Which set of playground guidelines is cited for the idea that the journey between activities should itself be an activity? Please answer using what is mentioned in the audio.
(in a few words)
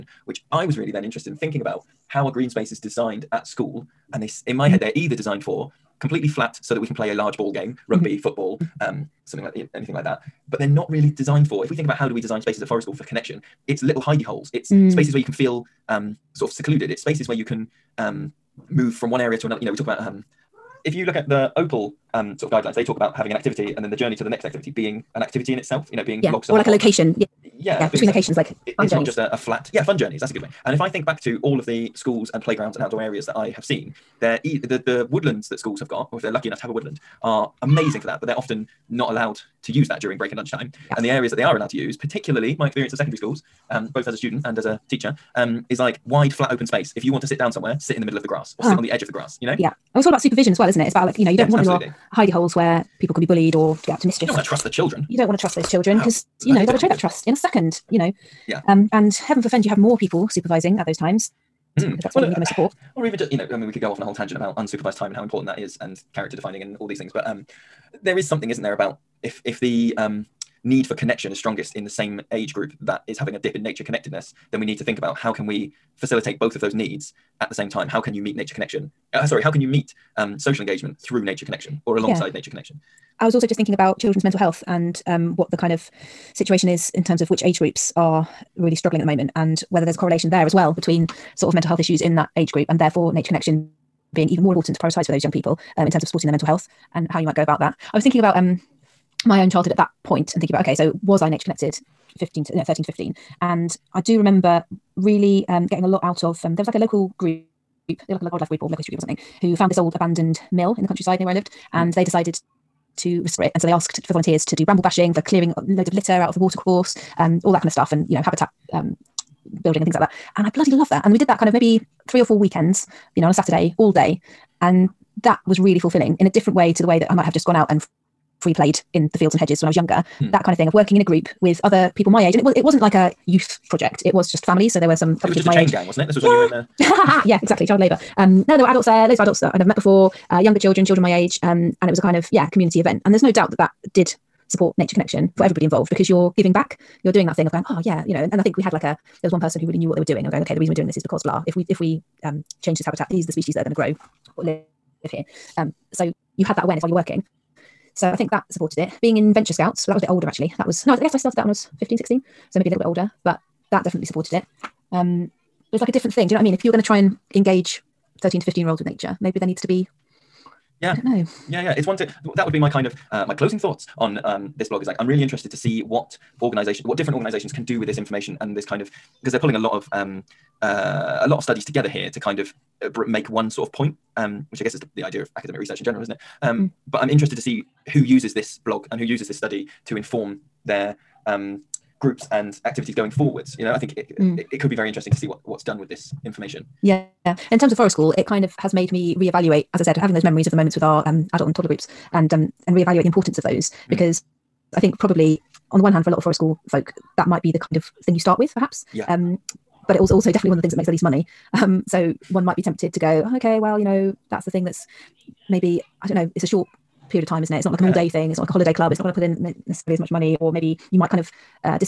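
Opal.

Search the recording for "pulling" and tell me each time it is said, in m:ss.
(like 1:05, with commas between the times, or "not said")
2:59.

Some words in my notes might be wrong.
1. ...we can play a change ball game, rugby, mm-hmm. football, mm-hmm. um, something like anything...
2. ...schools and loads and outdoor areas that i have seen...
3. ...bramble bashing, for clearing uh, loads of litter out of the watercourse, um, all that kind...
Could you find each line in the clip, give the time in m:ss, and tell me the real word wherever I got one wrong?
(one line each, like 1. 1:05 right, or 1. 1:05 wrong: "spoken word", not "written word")
1. 0:06 wrong: "large", not "change"
2. 0:31 wrong: "playgrounds", not "loads"
3. 1:54 right.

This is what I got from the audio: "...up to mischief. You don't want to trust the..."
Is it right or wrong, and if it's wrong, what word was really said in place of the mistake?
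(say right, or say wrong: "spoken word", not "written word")
right.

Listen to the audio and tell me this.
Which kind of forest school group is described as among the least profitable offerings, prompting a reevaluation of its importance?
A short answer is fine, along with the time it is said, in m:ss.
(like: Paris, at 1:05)
Adult and toddler groups, at 3:21.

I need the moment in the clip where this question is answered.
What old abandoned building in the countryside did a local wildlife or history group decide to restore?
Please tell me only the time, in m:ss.
1:50.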